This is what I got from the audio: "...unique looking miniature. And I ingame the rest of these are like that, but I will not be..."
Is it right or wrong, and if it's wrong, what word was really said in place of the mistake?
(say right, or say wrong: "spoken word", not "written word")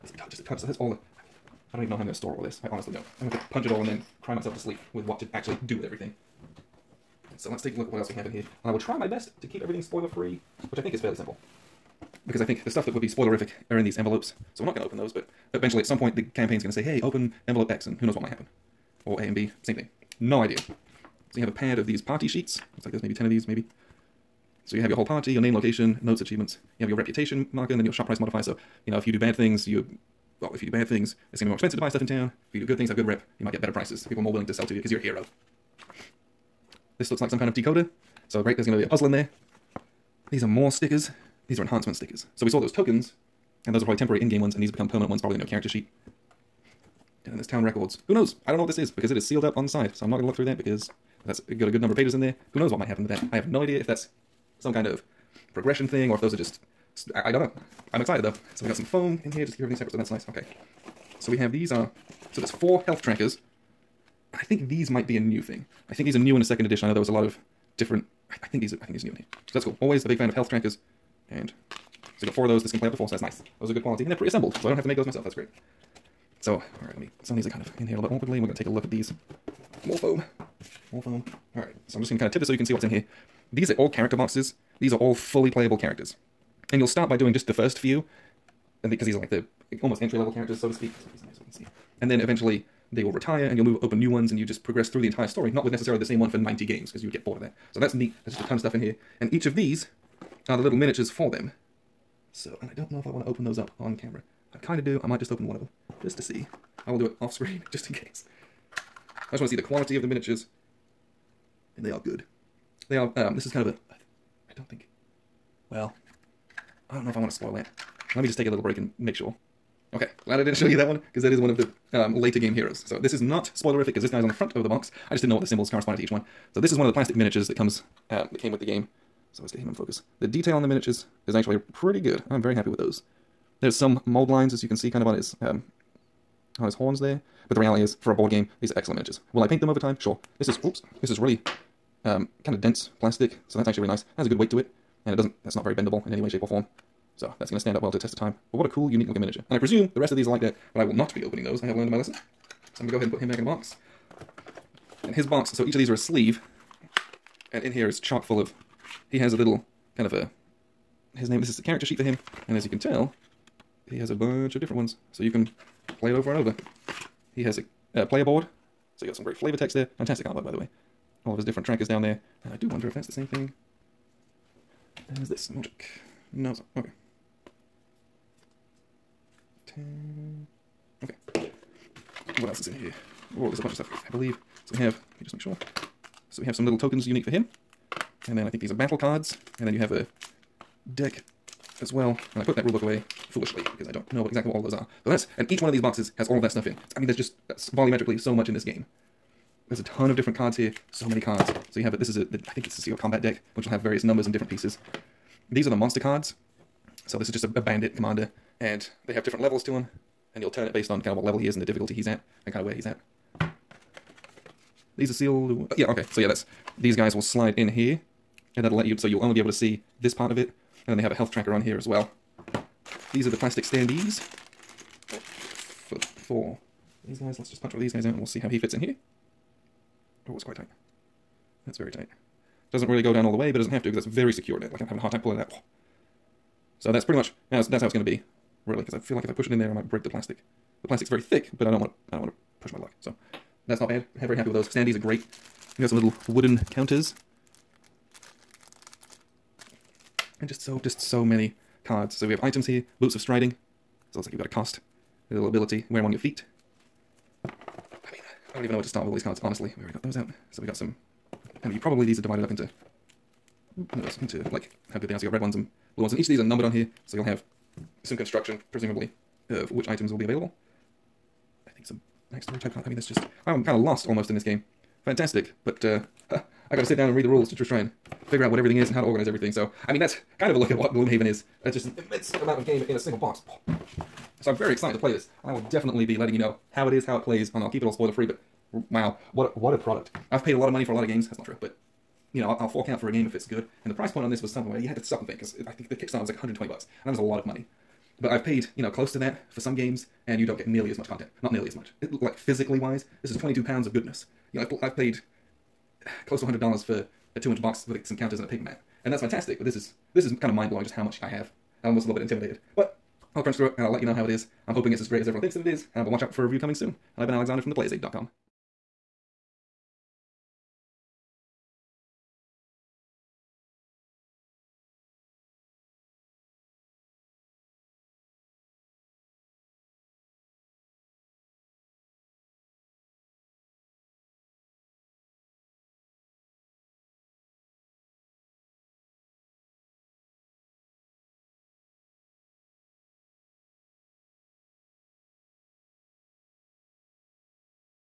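wrong: "presume", not "ingame".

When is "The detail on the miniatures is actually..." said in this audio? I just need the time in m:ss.
2:10.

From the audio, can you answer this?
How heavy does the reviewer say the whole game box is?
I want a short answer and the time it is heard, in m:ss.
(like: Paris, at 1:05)
22 pounds, at 5:03.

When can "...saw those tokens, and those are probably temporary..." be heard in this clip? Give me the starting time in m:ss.
0:42.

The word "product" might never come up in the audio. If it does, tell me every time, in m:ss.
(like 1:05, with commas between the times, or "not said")
4:49.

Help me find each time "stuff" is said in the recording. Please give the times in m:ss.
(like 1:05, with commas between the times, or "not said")
0:00, 0:12, 0:31, 1:38, 3:03, 3:16.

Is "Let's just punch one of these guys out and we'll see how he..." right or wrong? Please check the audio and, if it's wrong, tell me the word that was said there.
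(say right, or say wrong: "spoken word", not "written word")
right.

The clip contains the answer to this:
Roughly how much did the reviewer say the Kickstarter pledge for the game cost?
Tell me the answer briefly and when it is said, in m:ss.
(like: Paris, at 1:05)
$120, at 4:56.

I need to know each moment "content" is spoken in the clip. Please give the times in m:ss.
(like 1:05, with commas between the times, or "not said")
5:01.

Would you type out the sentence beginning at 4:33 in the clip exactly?
I'm kind of lost almost in this game.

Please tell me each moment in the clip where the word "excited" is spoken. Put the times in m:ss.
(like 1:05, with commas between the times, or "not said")
0:58, 4:44.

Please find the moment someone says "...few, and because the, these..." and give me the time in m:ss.
1:27.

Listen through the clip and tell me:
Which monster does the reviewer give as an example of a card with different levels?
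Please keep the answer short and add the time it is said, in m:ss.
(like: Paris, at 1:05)
Bandit commander, at 3:27.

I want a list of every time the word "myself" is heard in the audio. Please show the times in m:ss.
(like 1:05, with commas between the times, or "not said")
0:04, 1:15.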